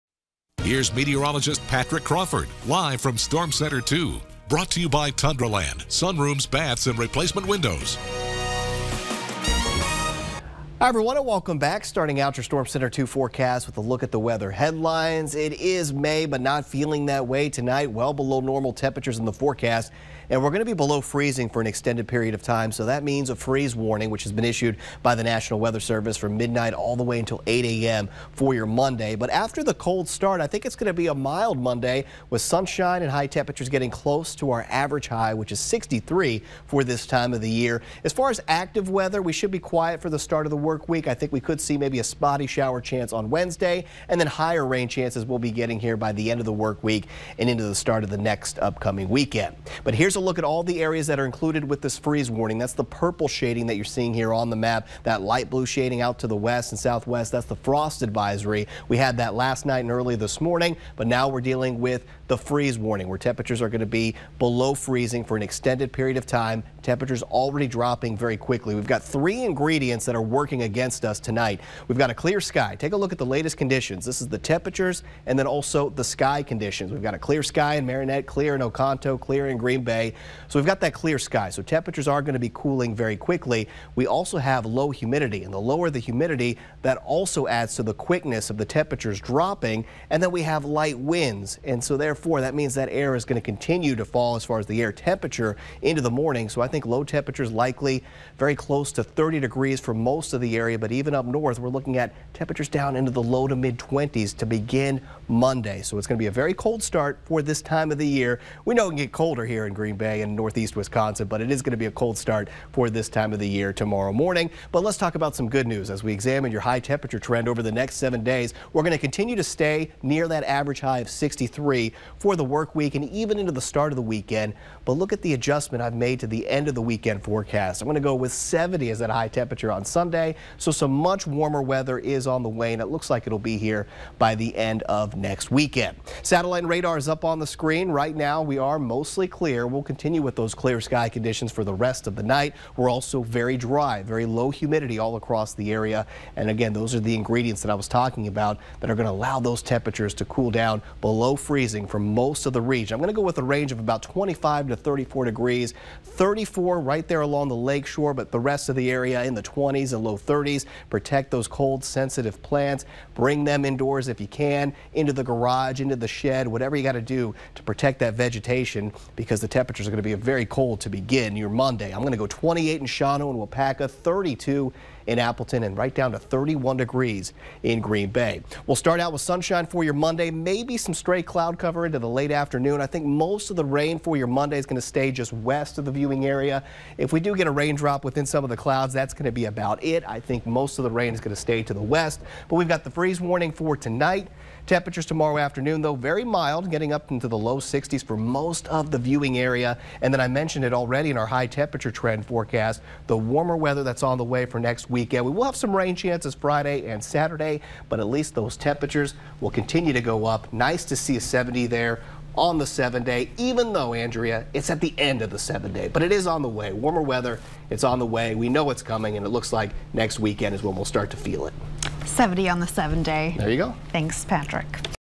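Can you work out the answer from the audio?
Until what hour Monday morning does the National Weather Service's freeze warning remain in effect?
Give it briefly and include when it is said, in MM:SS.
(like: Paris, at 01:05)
8 a.m., at 00:27.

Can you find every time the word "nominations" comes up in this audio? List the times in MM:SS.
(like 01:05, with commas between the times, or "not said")
not said.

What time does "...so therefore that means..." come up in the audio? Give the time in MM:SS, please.
01:31.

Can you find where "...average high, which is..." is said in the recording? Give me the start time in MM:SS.
00:34.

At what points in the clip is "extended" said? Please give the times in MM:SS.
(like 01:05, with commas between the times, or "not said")
00:21, 01:05.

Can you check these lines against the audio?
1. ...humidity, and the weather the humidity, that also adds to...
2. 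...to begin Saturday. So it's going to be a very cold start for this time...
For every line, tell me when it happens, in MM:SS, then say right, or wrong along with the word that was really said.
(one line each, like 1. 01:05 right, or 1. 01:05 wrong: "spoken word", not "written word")
1. 01:24 wrong: "lower", not "weather"
2. 01:44 wrong: "Monday", not "Saturday".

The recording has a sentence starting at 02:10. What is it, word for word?
So some much warmer weather is on the way, and it looks like it'll be here by the end of next weekend.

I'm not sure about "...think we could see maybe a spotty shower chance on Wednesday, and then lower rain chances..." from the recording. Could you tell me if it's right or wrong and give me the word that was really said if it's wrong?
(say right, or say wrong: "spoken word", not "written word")
wrong: "higher", not "lower".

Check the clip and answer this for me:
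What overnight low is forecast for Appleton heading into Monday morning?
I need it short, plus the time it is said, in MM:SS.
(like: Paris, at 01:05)
32, at 02:53.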